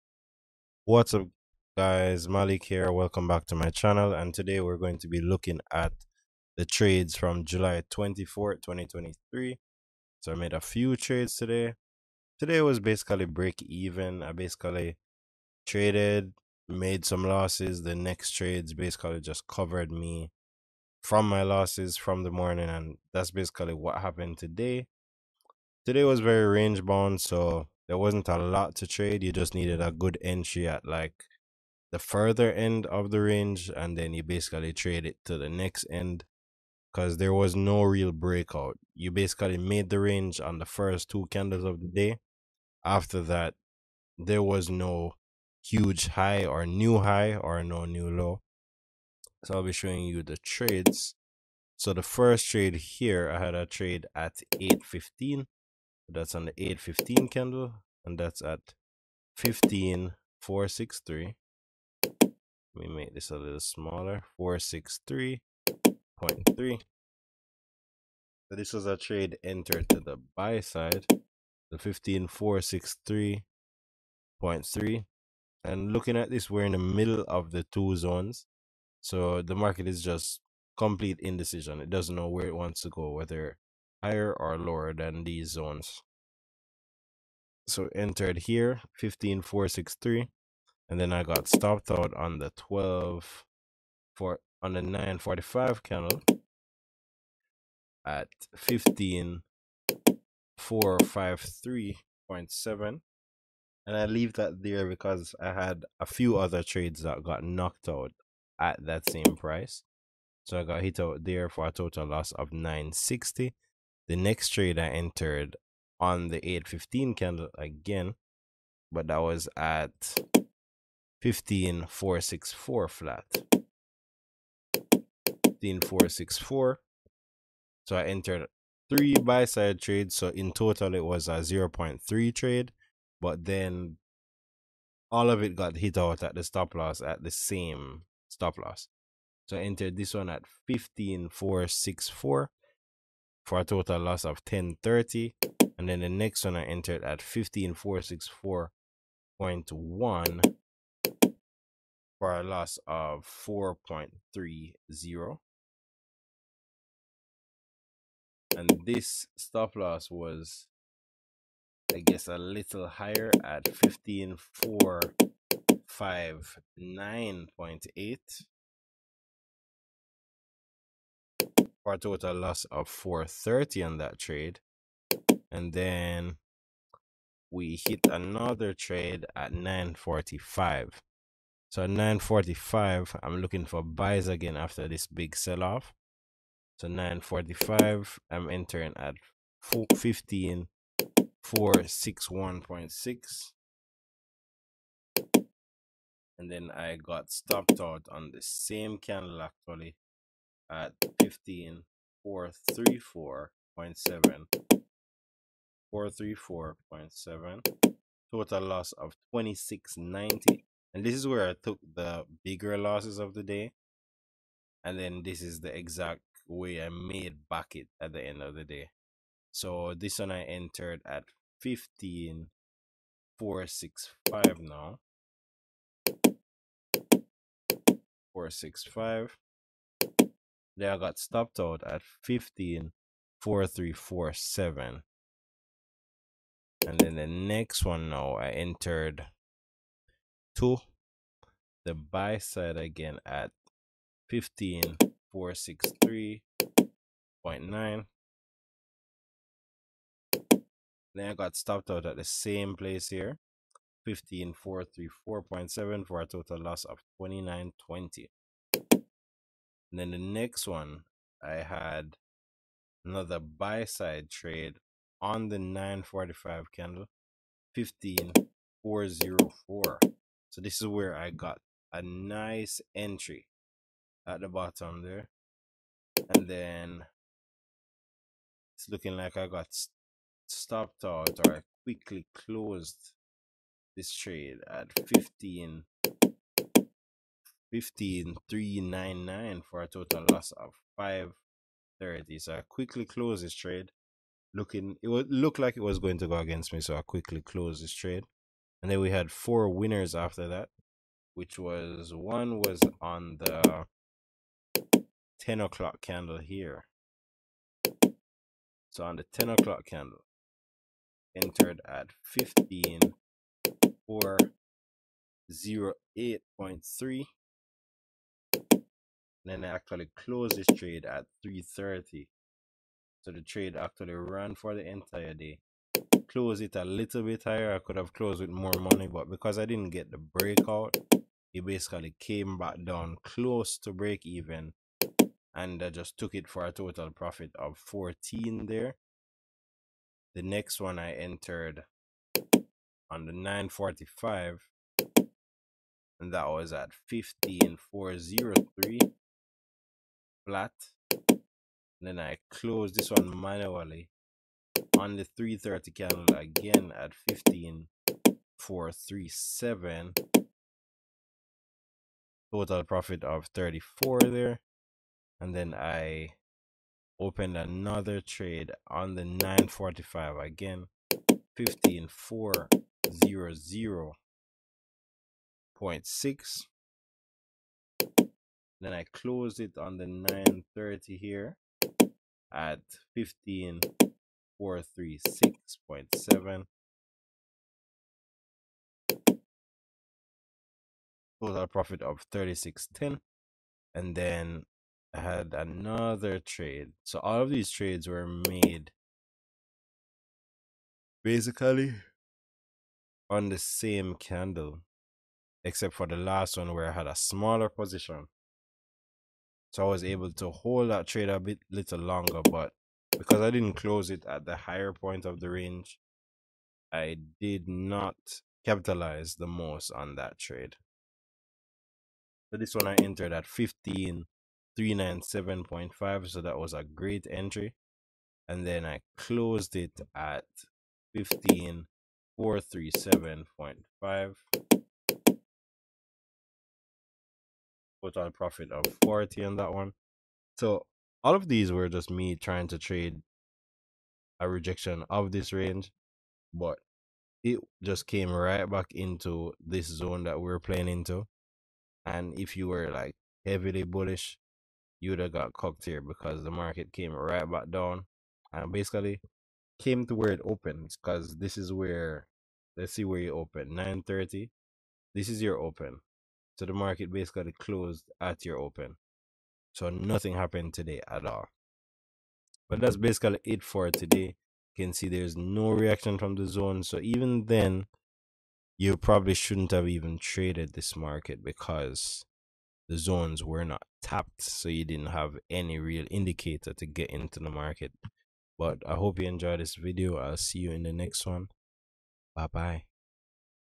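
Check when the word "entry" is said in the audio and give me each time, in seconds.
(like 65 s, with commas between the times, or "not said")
30 s, 272 s, 427 s.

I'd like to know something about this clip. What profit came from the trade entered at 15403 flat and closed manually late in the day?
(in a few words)
34.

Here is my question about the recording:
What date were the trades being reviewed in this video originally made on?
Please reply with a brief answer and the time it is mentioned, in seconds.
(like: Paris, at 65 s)
July 24, 2023, at 7 s.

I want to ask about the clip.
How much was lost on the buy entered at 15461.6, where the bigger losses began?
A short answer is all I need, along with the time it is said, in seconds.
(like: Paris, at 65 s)
2690, at 209 s.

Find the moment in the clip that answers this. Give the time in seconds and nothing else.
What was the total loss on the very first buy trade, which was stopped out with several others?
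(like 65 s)
112 s.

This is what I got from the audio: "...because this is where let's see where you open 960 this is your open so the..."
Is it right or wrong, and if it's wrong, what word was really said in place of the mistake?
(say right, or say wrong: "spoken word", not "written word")
wrong: "930", not "960".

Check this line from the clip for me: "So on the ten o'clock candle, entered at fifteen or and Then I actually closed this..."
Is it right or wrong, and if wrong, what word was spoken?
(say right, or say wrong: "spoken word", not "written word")
right.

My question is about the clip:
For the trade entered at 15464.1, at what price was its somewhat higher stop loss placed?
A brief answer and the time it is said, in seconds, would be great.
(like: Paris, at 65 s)
15459.8, at 163 s.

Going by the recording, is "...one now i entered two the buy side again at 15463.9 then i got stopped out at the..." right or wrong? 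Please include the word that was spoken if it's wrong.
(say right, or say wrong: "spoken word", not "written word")
right.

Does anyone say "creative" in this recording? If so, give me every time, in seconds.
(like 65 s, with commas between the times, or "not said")
not said.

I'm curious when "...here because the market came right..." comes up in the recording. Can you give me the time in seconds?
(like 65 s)
455 s.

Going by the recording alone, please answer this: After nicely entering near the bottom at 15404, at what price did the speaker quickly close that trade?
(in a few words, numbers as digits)
15399.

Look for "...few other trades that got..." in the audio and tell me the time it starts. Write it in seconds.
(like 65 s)
106 s.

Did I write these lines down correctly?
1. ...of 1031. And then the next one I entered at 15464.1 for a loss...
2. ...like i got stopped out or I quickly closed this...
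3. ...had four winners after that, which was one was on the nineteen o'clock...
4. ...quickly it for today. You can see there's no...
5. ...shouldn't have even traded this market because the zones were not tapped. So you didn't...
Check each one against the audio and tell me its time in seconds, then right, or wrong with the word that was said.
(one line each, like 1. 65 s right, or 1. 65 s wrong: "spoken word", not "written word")
1. 144 s wrong: "1030", not "1031"
2. 279 s right
3. 299 s wrong: "ten", not "nineteen"
4. 472 s wrong: "basically", not "quickly"
5. 479 s right.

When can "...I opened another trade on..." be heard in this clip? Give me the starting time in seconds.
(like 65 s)
365 s.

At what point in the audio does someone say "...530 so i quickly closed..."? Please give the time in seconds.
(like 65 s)
290 s.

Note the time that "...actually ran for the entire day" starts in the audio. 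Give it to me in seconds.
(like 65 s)
323 s.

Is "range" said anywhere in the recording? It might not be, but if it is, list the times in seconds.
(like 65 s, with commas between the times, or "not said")
26 s, 33 s, 39 s, 415 s, 445 s.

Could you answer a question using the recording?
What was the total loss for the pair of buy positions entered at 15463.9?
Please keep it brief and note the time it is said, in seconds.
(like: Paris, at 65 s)
2920, at 257 s.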